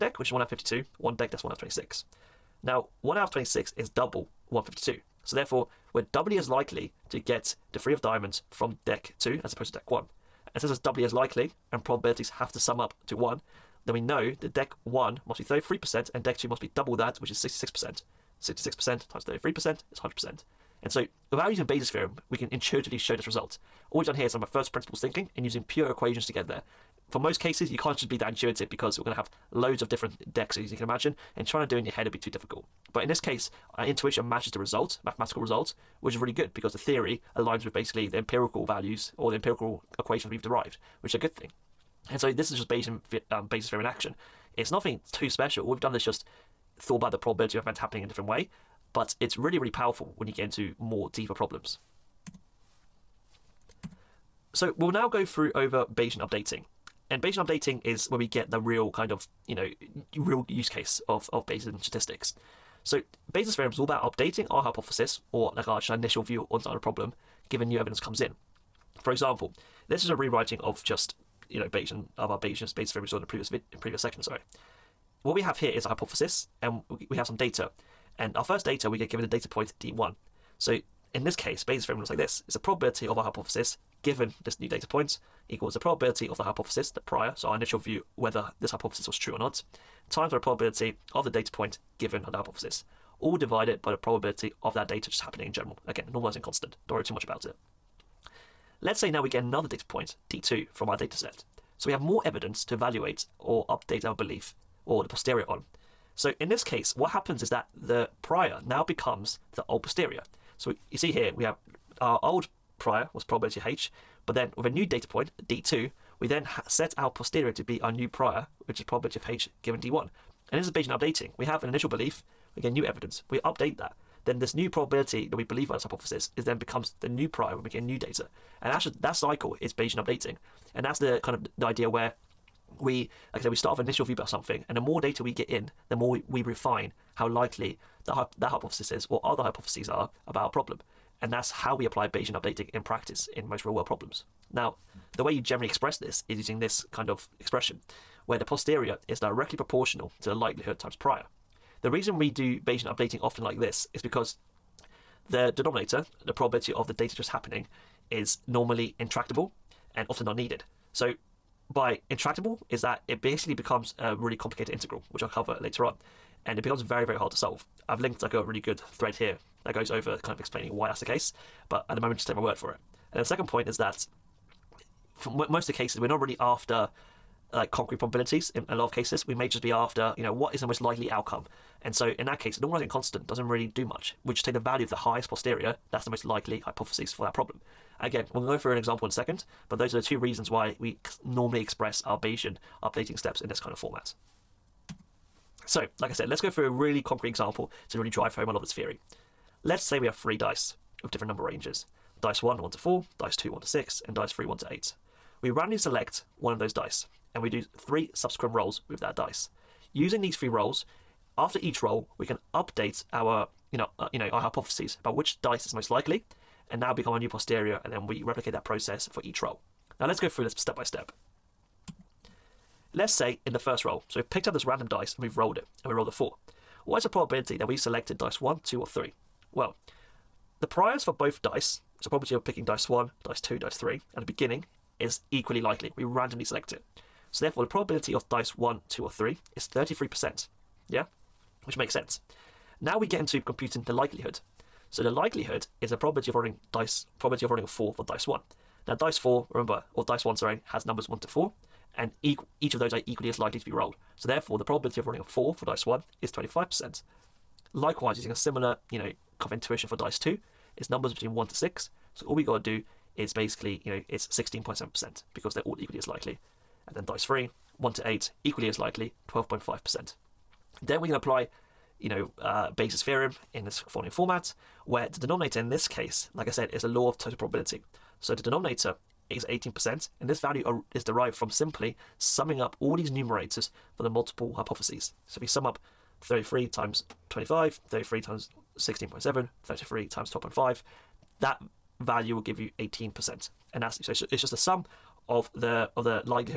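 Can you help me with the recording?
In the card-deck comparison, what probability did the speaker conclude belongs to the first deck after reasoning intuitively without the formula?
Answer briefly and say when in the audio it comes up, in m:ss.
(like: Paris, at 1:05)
33%, at 0:14.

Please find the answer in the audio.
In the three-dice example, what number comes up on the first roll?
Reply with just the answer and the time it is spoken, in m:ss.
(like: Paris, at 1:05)
4, at 3:46.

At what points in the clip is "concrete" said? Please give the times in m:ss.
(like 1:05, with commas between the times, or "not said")
2:57, 3:17.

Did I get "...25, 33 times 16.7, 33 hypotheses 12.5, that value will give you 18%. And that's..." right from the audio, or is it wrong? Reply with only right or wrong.
wrong.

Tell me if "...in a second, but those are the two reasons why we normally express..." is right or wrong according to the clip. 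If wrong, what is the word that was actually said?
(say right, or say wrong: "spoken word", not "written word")
right.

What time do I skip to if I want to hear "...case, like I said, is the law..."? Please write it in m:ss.
4:35.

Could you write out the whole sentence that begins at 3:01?
And so in that case, normalizing constant doesn't really do much.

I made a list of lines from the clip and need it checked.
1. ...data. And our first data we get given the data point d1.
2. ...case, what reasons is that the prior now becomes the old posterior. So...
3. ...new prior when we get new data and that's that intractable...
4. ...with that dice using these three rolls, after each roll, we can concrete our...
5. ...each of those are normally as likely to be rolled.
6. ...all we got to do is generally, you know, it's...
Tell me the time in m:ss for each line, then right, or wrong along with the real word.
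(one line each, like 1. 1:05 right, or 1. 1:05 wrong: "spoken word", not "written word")
1. 1:17 right
2. 1:46 wrong: "happens", not "reasons"
3. 2:07 wrong: "cycle", not "intractable"
4. 3:28 wrong: "update", not "concrete"
5. 4:12 wrong: "equally", not "normally"
6. 4:22 wrong: "basically", not "generally".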